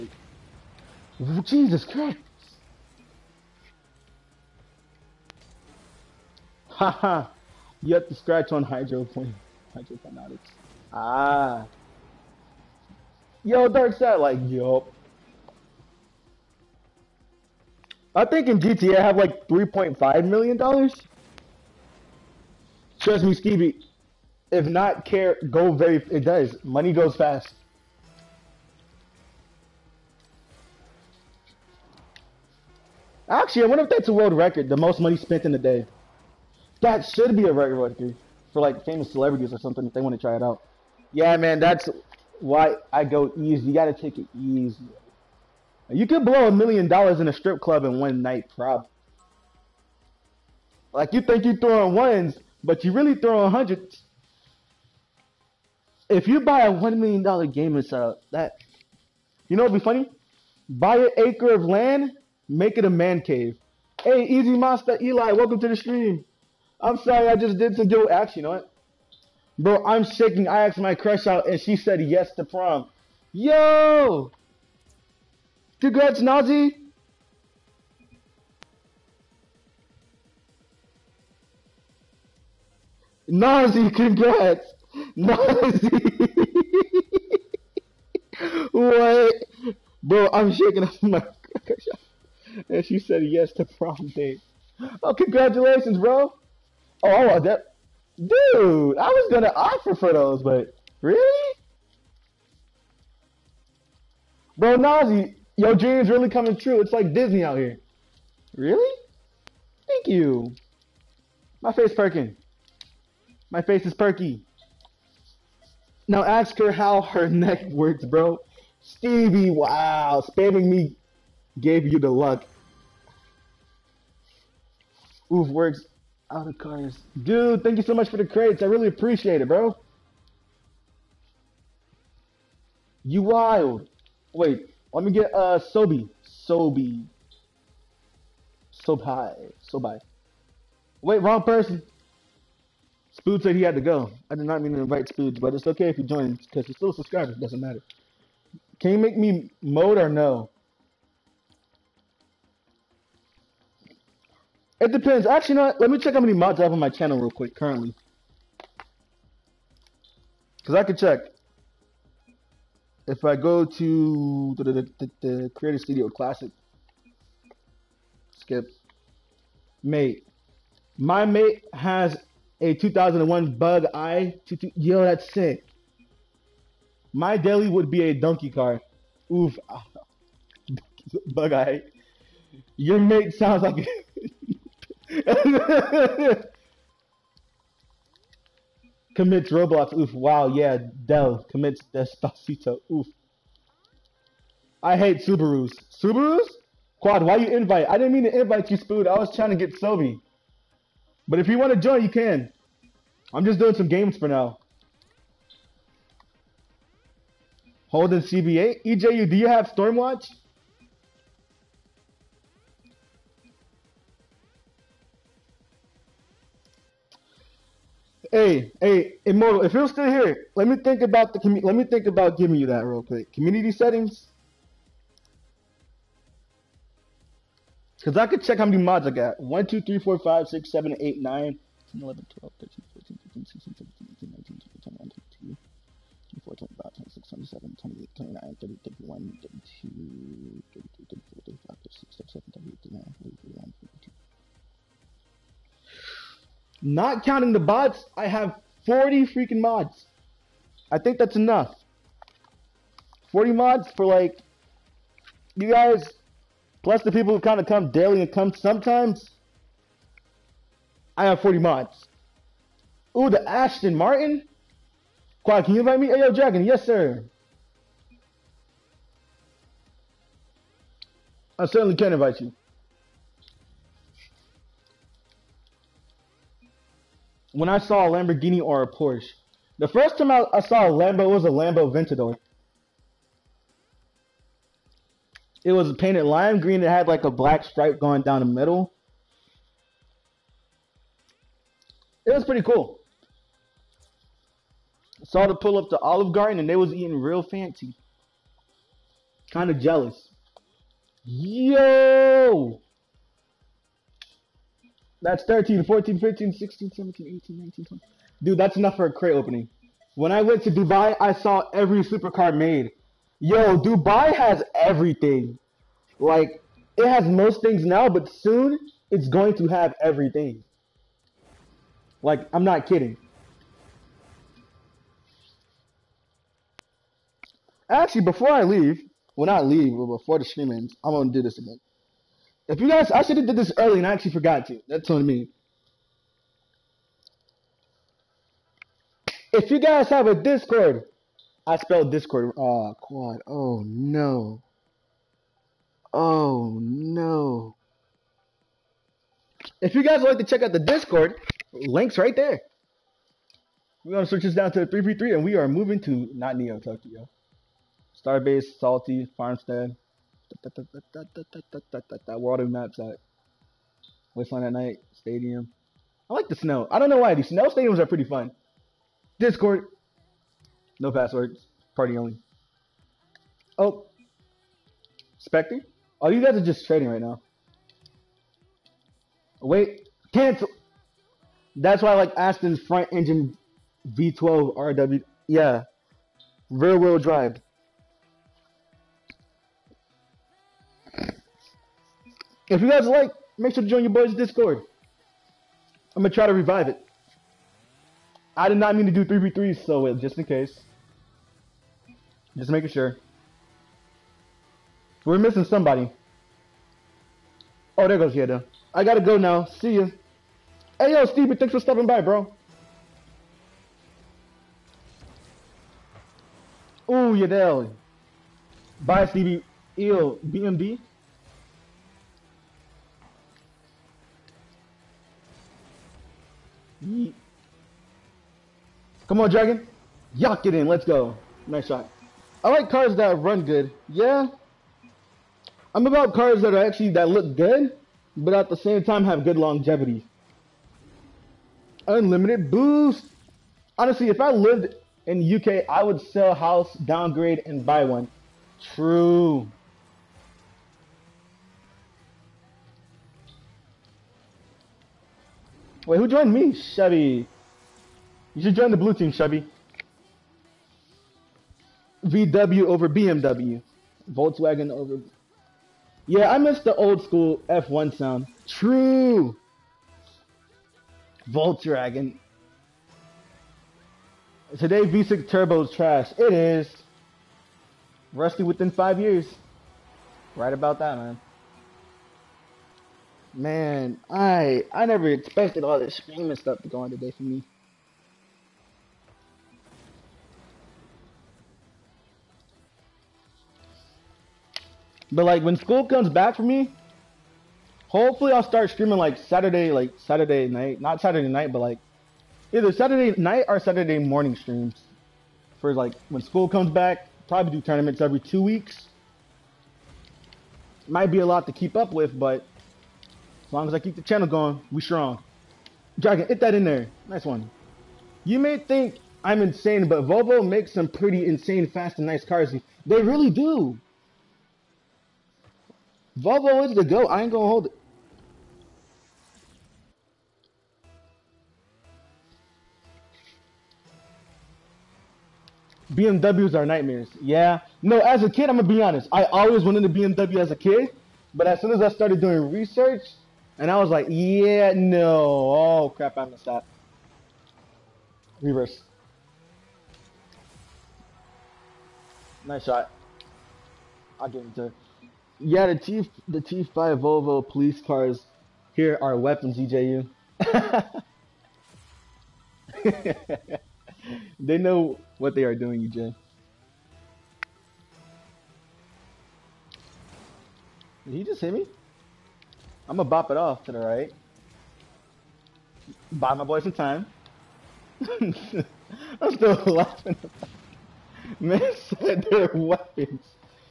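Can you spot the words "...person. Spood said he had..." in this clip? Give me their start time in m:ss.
2:21.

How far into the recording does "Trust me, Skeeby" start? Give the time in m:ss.
0:23.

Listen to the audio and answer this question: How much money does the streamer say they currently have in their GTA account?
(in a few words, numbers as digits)
$3.5 million.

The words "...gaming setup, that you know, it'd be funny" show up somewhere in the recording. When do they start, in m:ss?
0:57.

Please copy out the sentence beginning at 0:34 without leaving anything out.
The most money spent in a day.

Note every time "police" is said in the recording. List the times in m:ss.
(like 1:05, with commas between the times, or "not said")
9:17.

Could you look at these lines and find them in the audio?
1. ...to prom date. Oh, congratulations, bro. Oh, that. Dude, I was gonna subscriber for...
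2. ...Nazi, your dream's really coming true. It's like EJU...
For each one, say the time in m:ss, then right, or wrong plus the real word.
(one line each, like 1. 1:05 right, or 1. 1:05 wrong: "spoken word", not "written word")
1. 1:33 wrong: "offer", not "subscriber"
2. 1:44 wrong: "Disney", not "EJU".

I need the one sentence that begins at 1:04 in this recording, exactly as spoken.
Hey, Easy Master Eli, welcome to the stream.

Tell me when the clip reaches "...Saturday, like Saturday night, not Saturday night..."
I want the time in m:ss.
8:19.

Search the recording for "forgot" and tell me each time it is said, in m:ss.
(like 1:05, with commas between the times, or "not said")
5:34.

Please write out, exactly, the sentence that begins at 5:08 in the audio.
Dude, that's enough for a crate opening.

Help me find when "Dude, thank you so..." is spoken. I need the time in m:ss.
2:07.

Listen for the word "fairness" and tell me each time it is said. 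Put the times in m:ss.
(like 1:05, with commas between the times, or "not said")
not said.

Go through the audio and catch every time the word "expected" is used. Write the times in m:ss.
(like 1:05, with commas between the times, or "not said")
8:05.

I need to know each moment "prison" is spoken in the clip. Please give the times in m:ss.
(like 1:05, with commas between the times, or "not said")
not said.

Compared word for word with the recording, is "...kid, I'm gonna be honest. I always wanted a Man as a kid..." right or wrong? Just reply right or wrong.
wrong.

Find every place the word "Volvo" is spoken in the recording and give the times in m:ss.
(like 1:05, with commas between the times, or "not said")
8:40, 8:46, 9:17.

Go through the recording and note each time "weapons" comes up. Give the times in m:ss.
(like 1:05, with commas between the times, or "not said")
9:19, 9:42.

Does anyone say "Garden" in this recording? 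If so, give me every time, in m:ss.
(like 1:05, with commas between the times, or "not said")
4:56.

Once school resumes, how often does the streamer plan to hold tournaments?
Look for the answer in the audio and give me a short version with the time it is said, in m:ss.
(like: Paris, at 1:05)
every two weeks, at 8:28.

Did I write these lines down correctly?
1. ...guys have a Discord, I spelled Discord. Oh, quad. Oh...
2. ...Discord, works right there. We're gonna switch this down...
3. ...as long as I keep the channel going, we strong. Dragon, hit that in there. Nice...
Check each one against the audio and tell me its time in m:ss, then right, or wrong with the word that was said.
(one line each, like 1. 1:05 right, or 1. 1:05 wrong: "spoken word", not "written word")
1. 5:39 right
2. 5:50 wrong: "links", not "works"
3. 8:33 right.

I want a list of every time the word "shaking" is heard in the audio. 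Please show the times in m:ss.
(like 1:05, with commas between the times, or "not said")
1:10, 1:30.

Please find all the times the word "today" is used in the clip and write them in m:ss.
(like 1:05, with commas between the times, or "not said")
7:54, 8:07.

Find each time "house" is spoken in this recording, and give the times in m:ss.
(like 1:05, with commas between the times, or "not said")
7:26.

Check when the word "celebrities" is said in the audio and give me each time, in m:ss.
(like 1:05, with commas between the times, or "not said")
0:39.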